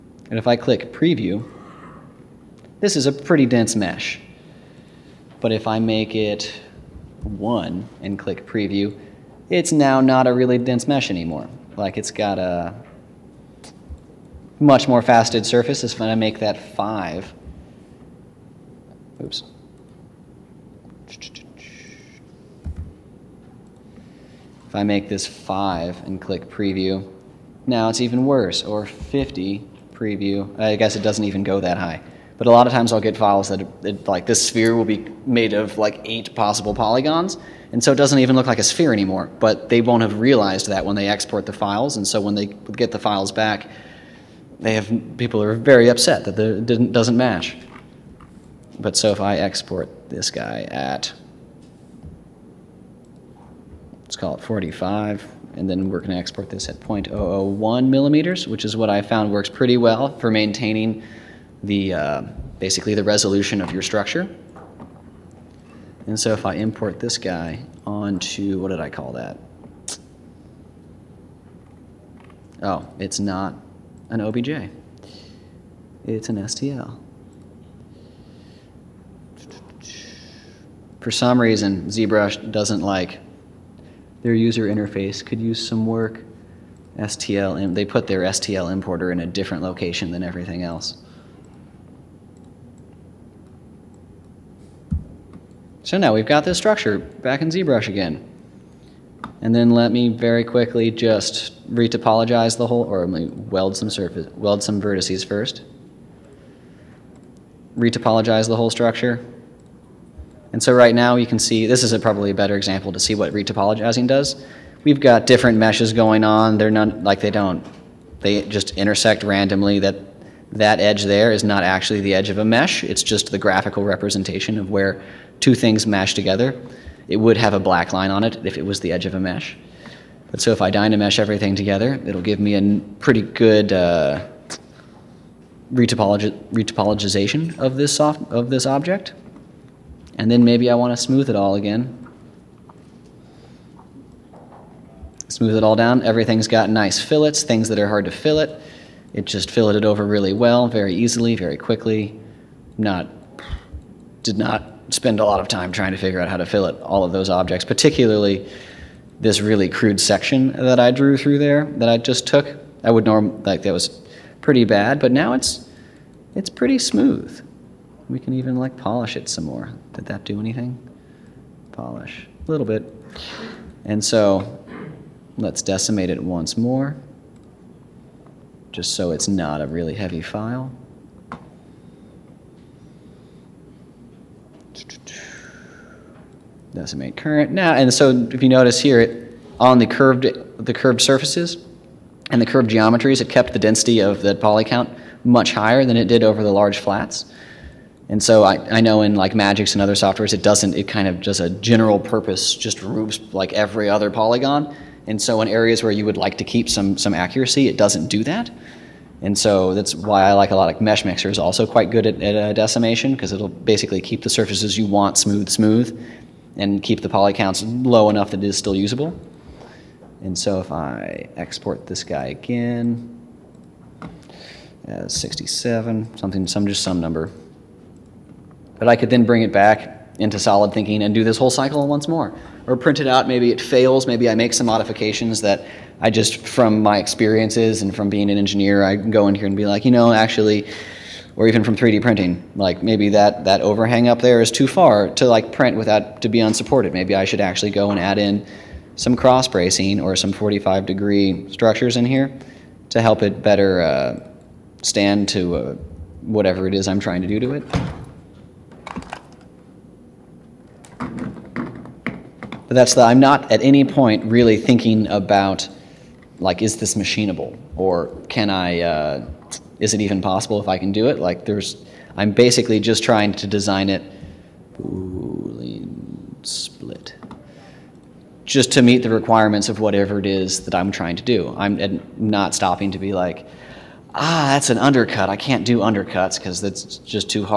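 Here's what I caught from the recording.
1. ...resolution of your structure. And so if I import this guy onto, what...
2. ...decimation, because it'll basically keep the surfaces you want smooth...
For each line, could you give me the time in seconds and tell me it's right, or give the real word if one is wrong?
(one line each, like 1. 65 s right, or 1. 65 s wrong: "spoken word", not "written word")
1. 63 s right
2. 212 s right.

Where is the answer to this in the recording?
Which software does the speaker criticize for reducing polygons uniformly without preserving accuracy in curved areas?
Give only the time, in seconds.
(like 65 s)
199 s.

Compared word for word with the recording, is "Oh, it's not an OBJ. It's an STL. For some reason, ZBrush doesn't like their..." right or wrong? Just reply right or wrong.
right.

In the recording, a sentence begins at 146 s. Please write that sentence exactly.
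Everything's got nice fillets, things that are hard to fillet.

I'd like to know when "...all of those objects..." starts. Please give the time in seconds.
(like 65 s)
156 s.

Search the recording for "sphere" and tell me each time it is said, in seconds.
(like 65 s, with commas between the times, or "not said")
34 s, 38 s.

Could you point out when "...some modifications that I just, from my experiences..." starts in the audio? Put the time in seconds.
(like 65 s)
234 s.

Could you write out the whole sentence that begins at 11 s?
Like it's got a much more faceted surface.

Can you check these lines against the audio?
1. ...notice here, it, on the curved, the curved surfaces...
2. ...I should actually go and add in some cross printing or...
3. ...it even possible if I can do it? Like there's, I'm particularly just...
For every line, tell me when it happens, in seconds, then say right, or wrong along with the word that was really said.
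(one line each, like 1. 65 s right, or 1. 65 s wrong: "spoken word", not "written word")
1. 188 s right
2. 247 s wrong: "bracing", not "printing"
3. 269 s wrong: "basically", not "particularly".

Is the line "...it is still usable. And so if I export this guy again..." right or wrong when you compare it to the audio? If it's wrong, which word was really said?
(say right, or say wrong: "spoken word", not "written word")
right.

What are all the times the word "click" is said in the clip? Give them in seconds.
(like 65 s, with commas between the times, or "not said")
0 s, 8 s, 26 s.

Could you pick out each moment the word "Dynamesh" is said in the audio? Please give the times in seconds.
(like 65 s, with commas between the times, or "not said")
130 s.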